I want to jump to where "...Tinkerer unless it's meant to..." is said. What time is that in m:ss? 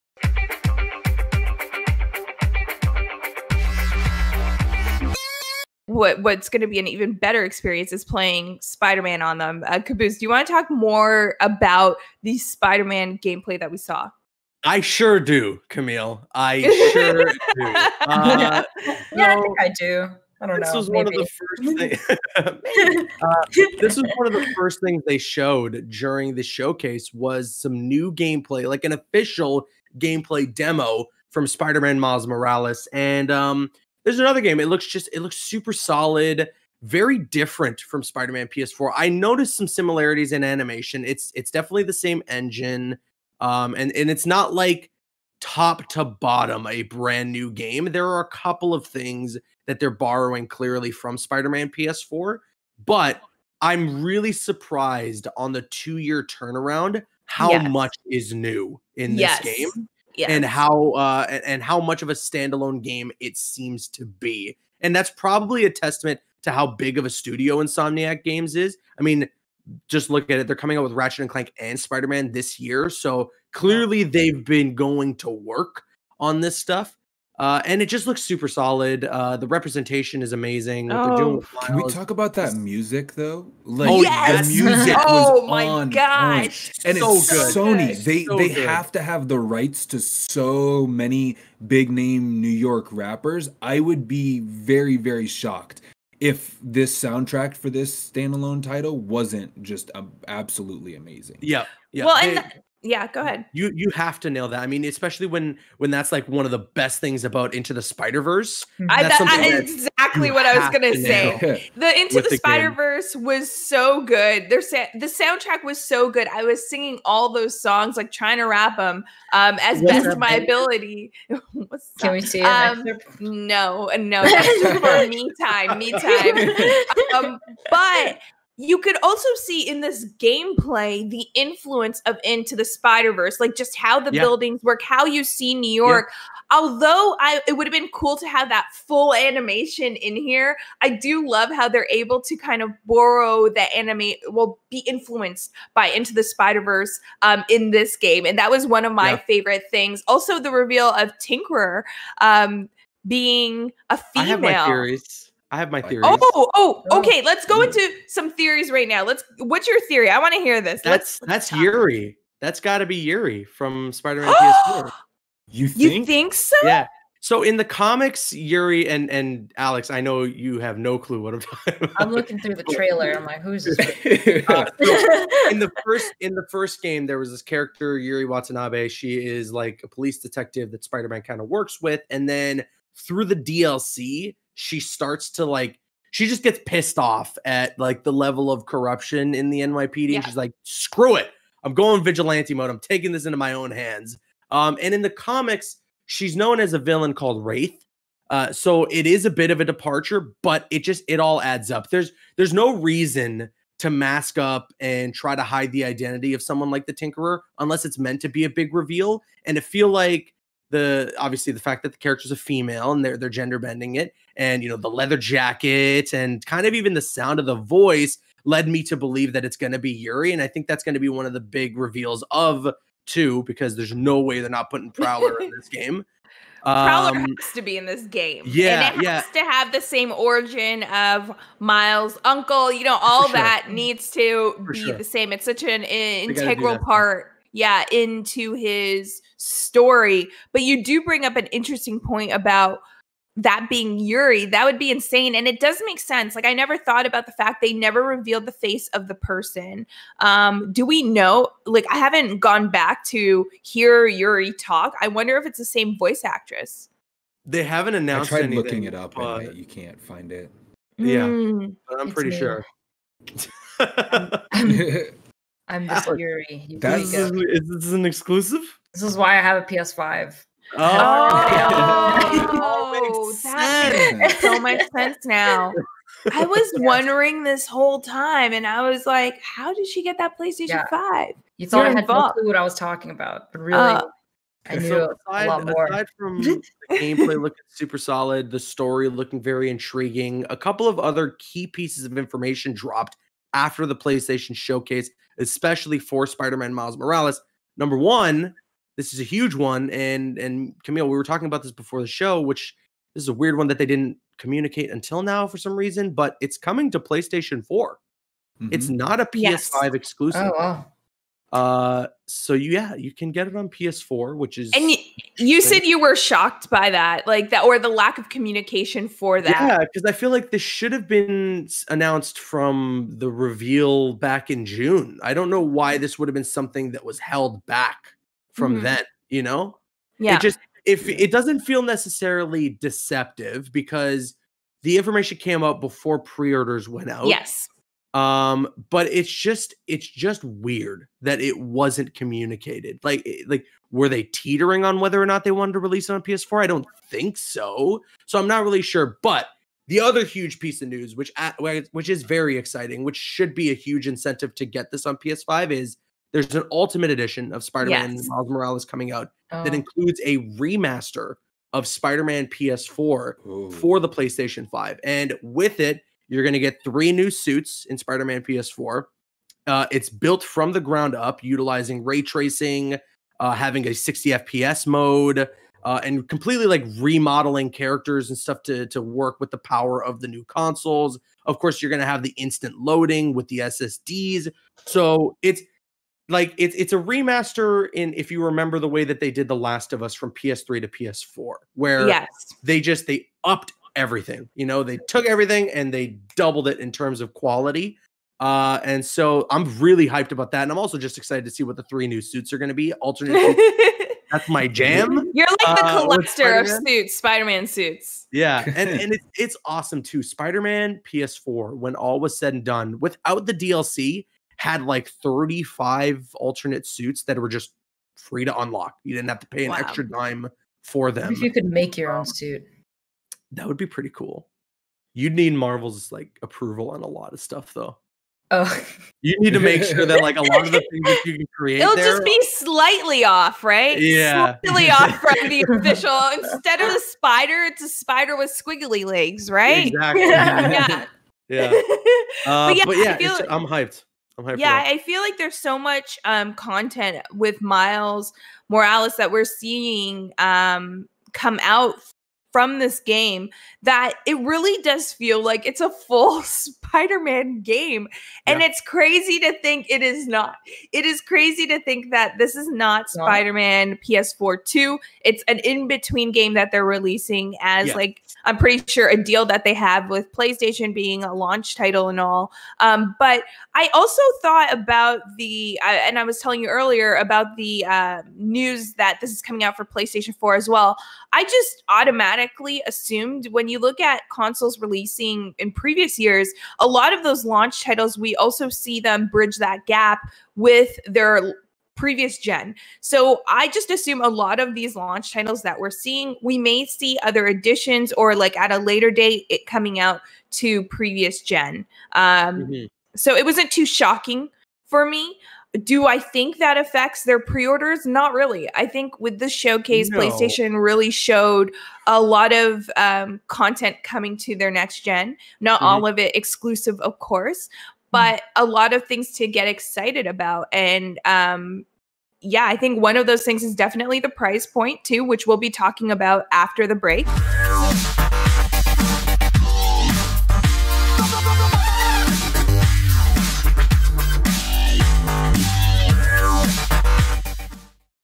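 3:26.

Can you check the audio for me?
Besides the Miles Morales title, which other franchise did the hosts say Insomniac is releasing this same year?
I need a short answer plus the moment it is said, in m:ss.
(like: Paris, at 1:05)
Ratchet and Clank, at 1:10.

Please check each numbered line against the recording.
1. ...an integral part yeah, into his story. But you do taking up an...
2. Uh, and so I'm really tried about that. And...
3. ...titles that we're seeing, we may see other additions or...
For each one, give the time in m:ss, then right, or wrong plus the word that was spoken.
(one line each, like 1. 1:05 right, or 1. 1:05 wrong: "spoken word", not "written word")
1. 3:55 wrong: "bring", not "taking"
2. 6:38 wrong: "hyped", not "tried"
3. 8:15 right.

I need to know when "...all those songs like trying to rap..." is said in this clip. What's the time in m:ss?
1:57.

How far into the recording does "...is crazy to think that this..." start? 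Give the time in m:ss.
7:41.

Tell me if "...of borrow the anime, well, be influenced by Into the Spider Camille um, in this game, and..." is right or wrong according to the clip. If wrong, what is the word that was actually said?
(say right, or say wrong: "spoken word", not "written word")
wrong: "Verse", not "Camille".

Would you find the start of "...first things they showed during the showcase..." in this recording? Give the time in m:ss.
0:24.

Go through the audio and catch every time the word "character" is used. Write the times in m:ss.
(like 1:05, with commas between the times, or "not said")
2:57, 3:31, 6:17.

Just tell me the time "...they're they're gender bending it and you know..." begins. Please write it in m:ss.
3:33.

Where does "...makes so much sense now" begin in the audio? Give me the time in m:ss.
4:34.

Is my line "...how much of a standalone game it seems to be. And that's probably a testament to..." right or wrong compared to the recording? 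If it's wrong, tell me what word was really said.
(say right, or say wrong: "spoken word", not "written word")
right.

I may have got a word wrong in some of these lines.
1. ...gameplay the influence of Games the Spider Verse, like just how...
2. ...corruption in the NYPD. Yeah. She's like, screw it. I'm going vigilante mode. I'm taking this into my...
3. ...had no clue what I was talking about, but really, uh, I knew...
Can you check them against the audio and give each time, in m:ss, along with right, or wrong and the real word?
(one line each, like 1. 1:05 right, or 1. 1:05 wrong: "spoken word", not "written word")
1. 2:10 wrong: "Into", not "Games"
2. 3:08 right
3. 4:42 right.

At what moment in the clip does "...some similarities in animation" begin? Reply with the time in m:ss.
0:39.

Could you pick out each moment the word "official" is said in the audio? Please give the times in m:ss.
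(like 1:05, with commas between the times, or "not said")
0:28, 7:15.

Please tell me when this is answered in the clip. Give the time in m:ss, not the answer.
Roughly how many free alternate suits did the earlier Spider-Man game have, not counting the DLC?
6:55.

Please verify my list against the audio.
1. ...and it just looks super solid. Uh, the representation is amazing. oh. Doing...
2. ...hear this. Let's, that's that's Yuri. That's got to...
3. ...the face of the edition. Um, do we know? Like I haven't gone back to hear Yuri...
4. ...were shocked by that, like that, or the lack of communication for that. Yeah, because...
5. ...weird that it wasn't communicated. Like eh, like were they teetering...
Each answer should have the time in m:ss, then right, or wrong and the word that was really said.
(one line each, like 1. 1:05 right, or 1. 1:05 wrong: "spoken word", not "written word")
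1. 1:17 right
2. 2:40 right
3. 4:08 wrong: "person", not "edition"
4. 5:15 right
5. 5:40 right.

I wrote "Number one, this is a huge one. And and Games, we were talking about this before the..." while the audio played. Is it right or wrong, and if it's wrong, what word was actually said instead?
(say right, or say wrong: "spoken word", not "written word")
wrong: "Camille", not "Games".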